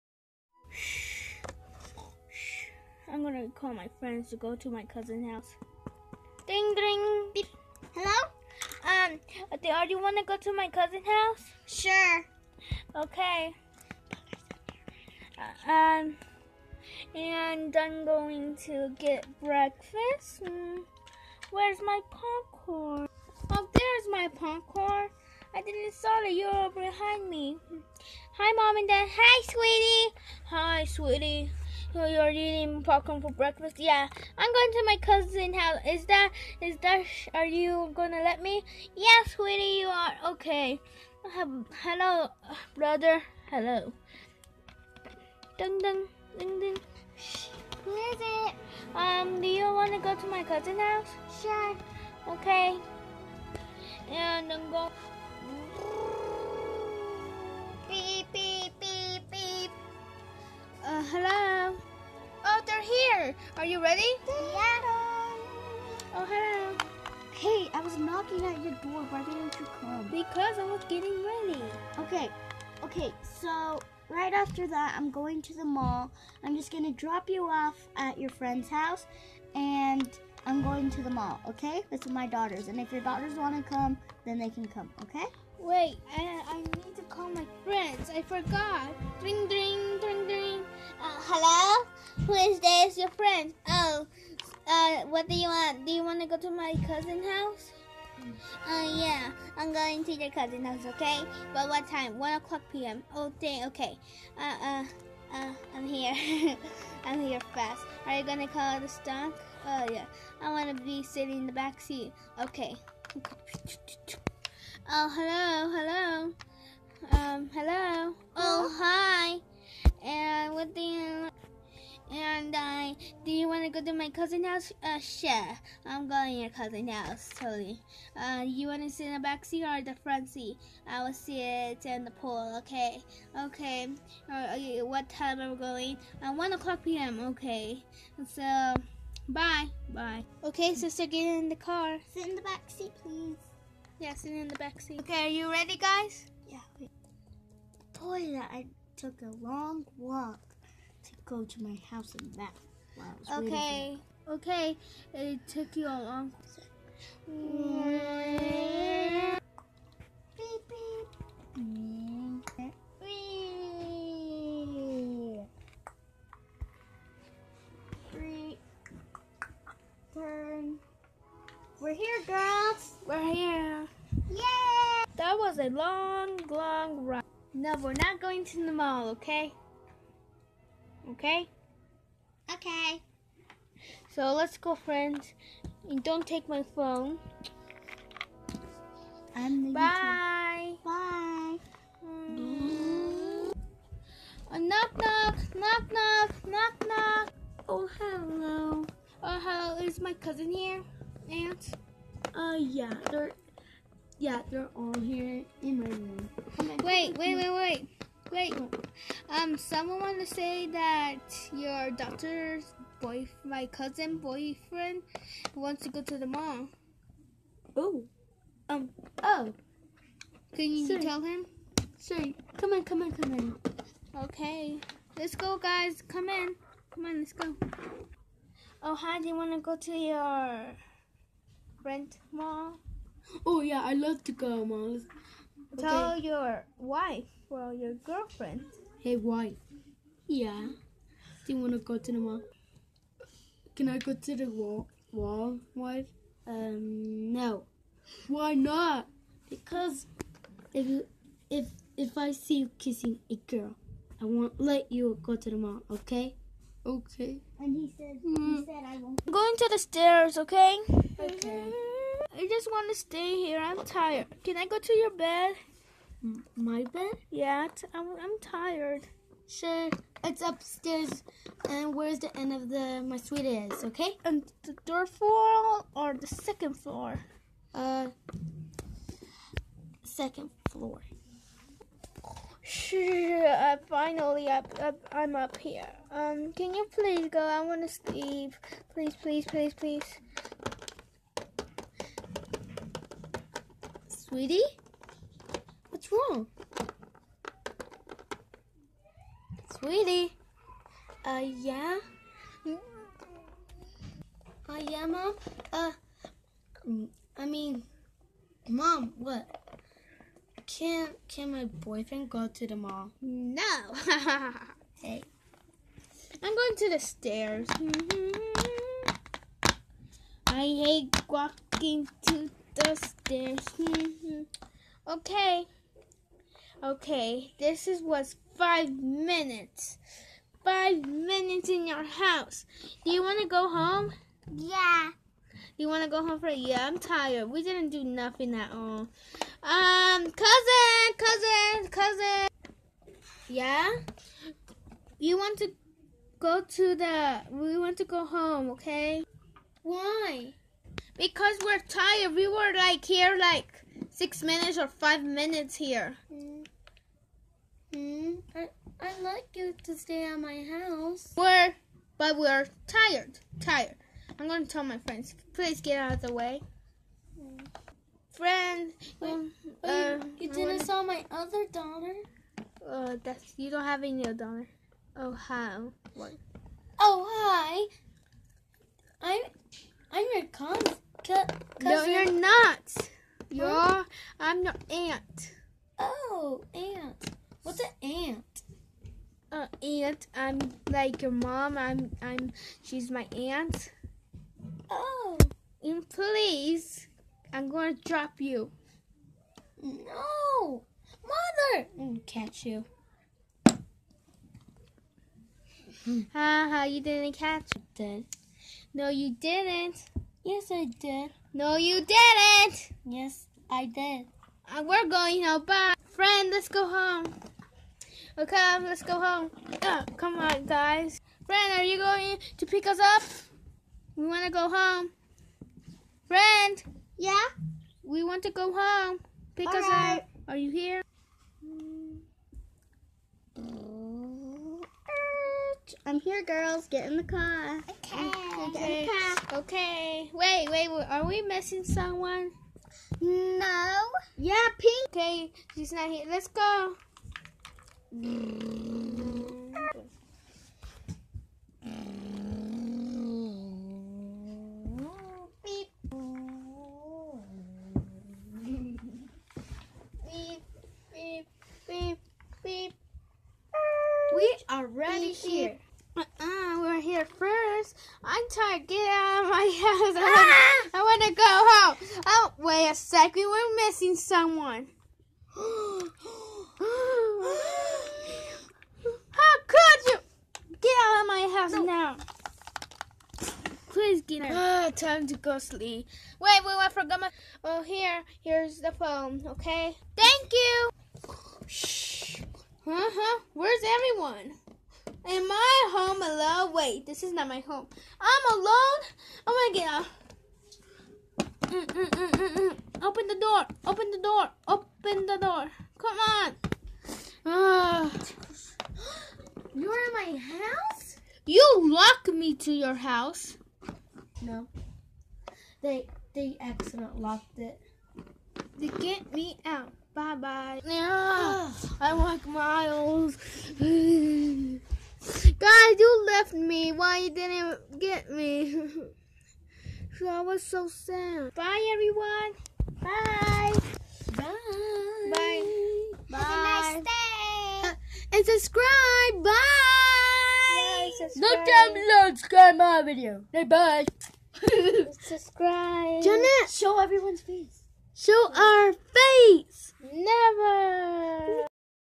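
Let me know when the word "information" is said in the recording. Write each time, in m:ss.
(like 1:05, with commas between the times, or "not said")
not said.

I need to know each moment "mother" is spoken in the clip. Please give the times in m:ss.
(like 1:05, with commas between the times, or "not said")
6:41.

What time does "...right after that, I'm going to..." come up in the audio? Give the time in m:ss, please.
1:14.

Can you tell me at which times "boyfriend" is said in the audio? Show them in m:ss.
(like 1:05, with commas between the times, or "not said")
3:34, 5:11.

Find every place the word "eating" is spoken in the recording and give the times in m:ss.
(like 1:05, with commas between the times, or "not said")
0:32.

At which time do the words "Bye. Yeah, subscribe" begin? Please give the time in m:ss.
8:59.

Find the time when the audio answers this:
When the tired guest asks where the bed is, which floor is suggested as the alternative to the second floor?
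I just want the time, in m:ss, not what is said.
4:34.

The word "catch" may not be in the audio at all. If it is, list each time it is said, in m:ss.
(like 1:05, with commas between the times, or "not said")
6:42, 6:47.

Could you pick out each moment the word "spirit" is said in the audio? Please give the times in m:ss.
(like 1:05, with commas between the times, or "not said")
not said.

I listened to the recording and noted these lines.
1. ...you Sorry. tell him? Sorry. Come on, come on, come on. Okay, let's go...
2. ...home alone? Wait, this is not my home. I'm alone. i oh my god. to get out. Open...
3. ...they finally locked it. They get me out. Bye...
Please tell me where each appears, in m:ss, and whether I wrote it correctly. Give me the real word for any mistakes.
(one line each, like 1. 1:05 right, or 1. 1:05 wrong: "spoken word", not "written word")
1. 3:40 right
2. 8:15 right
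3. 8:36 wrong: "accidentally", not "finally".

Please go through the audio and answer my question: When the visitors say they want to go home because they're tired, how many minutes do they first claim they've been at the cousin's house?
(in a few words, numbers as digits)
6 minutes.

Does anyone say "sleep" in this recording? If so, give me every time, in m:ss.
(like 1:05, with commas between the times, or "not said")
4:47, 8:05.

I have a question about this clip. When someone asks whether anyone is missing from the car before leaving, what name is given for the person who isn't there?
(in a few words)
Pink.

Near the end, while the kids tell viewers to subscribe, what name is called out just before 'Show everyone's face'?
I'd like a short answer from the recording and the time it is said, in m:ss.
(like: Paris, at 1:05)
Janet, at 9:06.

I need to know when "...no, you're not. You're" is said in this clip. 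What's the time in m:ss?
6:21.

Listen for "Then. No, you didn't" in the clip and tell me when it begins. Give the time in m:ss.
6:47.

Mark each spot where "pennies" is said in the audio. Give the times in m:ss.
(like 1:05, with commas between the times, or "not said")
not said.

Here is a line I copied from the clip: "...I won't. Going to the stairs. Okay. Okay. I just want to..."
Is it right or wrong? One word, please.
right.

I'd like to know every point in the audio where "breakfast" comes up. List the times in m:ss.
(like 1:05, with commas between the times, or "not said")
0:19, 0:33.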